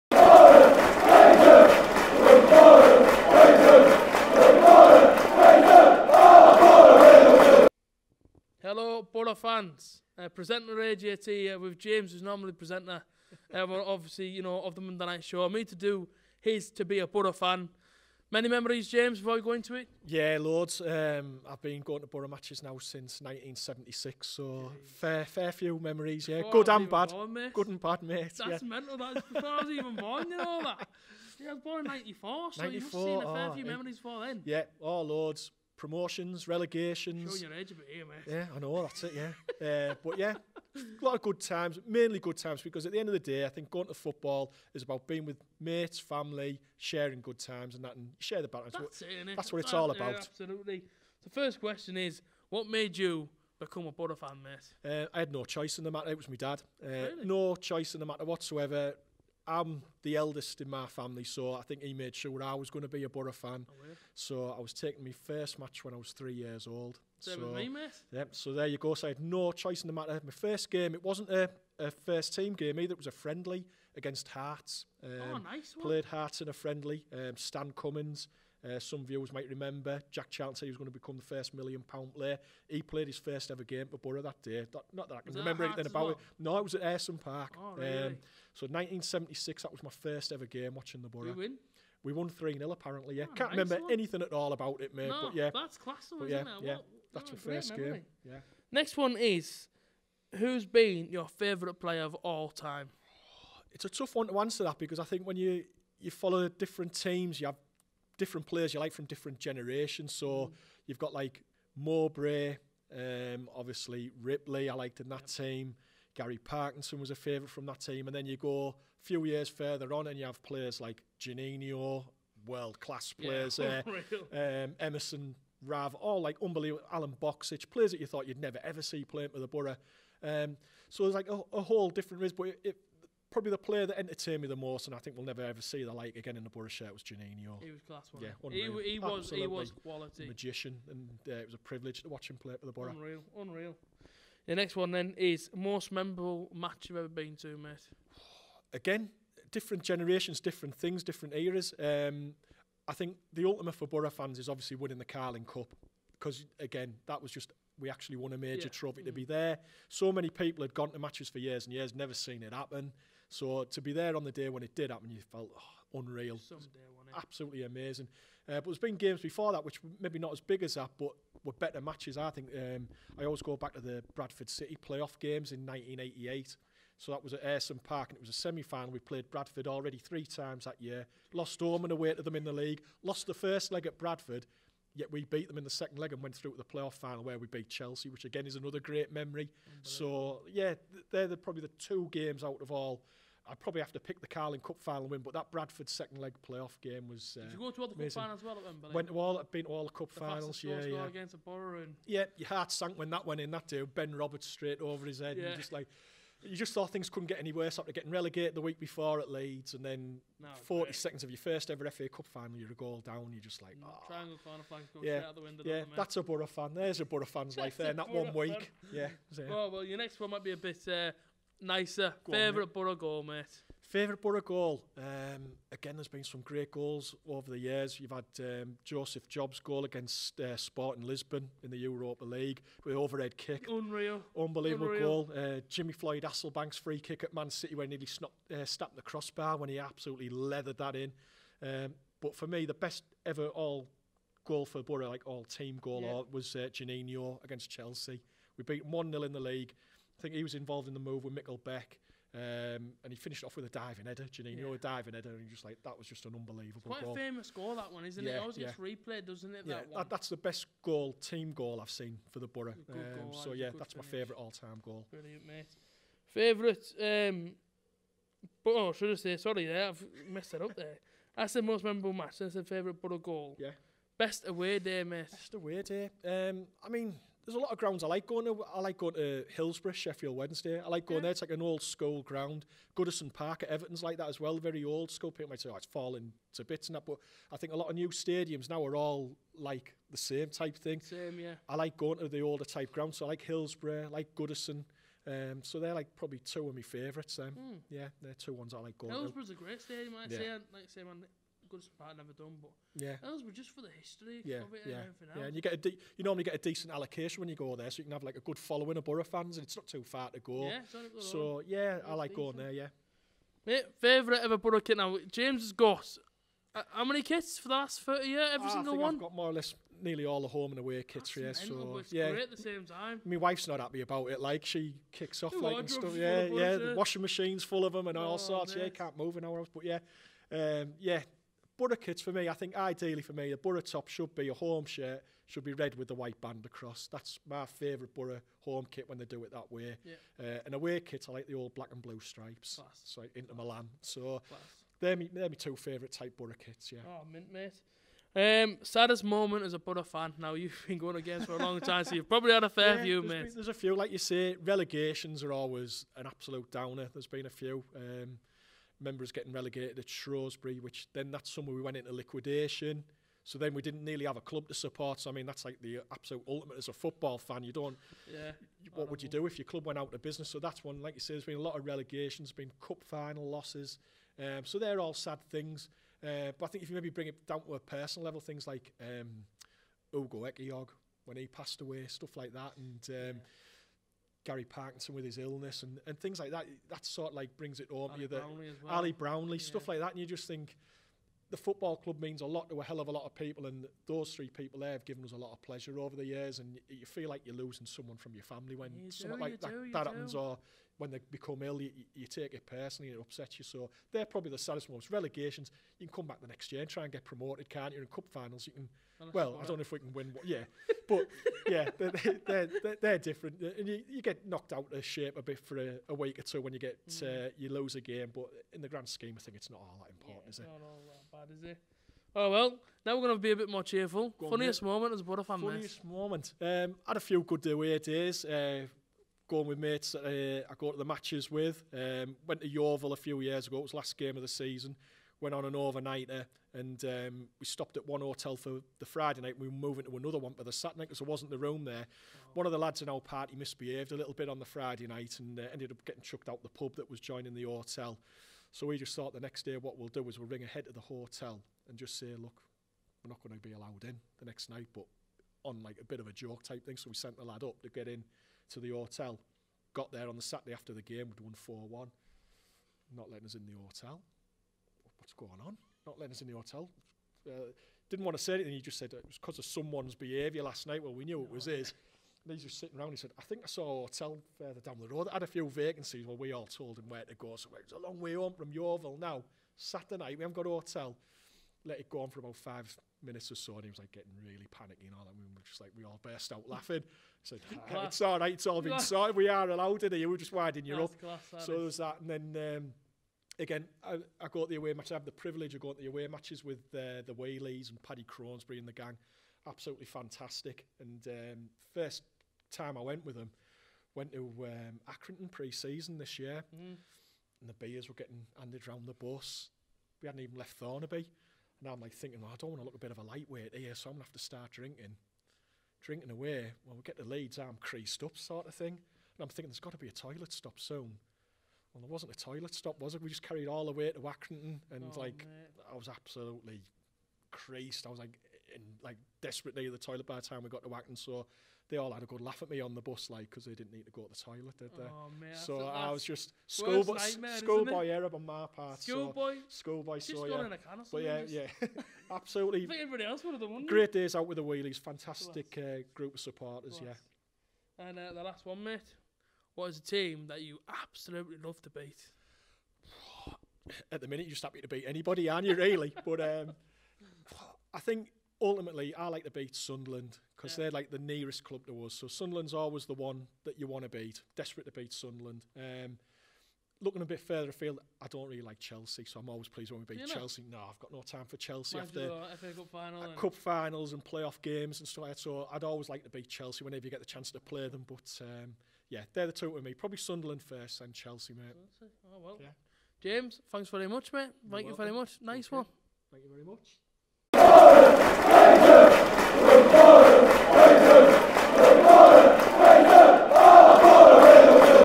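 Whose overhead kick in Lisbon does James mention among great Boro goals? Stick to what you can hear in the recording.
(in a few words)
Joseph Job.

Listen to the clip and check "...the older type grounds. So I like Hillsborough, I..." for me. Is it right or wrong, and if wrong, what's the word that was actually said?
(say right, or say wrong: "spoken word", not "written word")
right.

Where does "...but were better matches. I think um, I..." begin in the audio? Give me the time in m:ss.
2:50.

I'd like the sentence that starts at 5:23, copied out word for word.
My wife's not happy about it.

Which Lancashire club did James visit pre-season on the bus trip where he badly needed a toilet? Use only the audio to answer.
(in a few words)
Accrington.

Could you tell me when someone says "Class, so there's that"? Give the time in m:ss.
8:11.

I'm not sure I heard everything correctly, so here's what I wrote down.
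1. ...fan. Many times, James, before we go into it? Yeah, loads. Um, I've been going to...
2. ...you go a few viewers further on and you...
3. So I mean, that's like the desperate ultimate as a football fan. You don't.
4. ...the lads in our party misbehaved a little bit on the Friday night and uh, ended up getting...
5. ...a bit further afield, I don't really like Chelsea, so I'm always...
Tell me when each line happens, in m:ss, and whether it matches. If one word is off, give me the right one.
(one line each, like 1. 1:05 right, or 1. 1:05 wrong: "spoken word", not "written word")
1. 0:17 wrong: "memories", not "times"
2. 1:58 wrong: "years", not "viewers"
3. 6:05 wrong: "absolute", not "desperate"
4. 7:22 right
5. 9:27 right.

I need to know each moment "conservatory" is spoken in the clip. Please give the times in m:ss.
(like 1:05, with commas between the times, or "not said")
not said.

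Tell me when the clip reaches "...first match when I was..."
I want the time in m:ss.
1:05.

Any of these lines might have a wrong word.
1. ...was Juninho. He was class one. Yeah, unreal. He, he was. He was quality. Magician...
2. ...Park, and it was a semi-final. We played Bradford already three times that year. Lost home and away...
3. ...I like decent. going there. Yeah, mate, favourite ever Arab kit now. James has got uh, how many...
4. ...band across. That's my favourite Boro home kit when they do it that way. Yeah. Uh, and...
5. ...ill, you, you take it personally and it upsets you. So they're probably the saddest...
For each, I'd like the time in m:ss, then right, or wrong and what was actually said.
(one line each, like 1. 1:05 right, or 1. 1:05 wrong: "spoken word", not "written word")
1. 2:16 right
2. 2:57 right
3. 5:12 wrong: "Boro", not "Arab"
4. 5:36 right
5. 6:41 right.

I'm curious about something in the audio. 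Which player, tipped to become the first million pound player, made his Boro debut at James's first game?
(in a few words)
Stan Cummins.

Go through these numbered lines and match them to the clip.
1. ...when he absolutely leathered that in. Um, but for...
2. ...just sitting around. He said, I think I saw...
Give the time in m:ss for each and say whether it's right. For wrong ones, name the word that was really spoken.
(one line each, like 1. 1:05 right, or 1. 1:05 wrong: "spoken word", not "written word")
1. 3:59 right
2. 7:52 right.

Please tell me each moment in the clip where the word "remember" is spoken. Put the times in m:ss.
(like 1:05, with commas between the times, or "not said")
1:19, 1:25, 1:33.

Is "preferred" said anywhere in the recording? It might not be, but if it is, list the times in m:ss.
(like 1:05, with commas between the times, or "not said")
not said.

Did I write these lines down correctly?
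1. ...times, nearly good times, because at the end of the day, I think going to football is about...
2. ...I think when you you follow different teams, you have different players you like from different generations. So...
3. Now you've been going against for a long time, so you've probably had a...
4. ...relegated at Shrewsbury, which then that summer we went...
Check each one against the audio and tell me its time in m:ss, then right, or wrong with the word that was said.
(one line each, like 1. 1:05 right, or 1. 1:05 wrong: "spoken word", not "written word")
1. 0:41 wrong: "mainly", not "nearly"
2. 1:44 right
3. 5:50 right
4. 5:59 right.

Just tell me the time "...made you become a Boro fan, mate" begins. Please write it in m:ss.
0:52.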